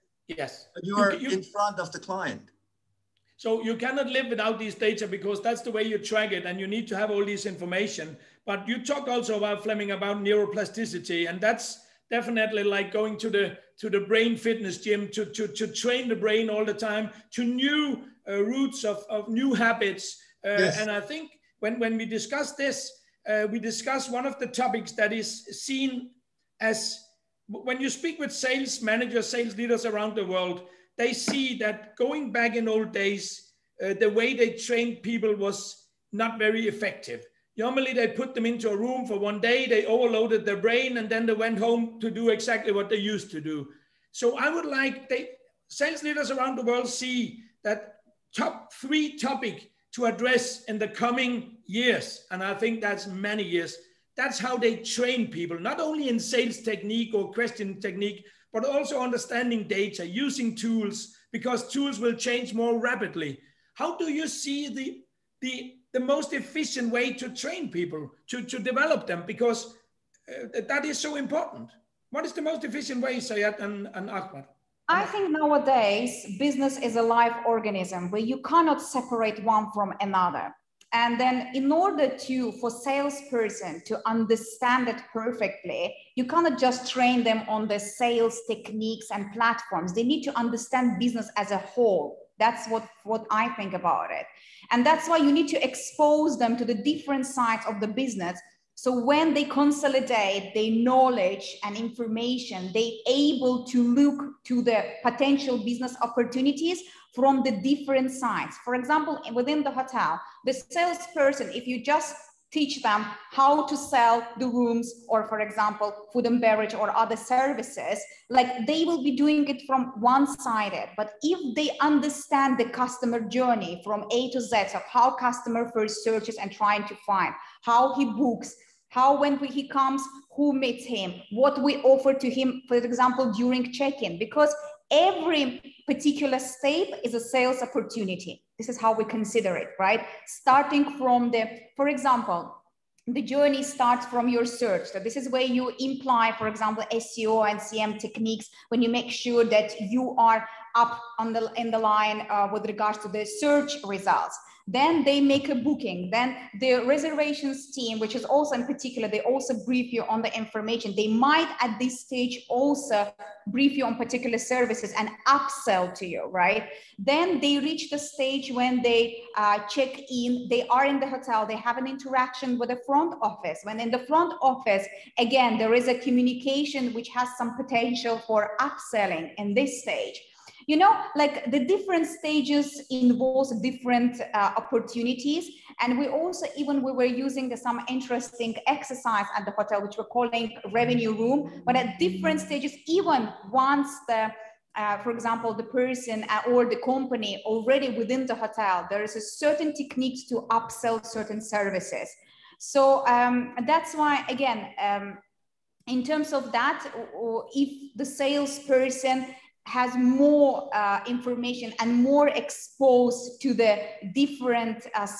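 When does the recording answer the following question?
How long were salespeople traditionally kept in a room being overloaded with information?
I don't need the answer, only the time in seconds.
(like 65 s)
39 s.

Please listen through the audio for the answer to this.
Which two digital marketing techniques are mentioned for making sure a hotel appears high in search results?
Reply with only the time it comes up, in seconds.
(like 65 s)
146 s.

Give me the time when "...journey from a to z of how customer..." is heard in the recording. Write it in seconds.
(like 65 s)
123 s.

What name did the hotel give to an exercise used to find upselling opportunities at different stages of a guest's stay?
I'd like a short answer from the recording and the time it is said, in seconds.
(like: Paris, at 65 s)
revenue room, at 190 s.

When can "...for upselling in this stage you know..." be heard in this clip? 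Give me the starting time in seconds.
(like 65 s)
178 s.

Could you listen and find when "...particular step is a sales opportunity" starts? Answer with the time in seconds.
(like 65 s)
135 s.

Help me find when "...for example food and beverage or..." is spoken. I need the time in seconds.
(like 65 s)
115 s.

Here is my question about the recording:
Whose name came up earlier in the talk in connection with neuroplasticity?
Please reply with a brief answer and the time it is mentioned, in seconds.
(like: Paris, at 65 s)
Fleming, at 9 s.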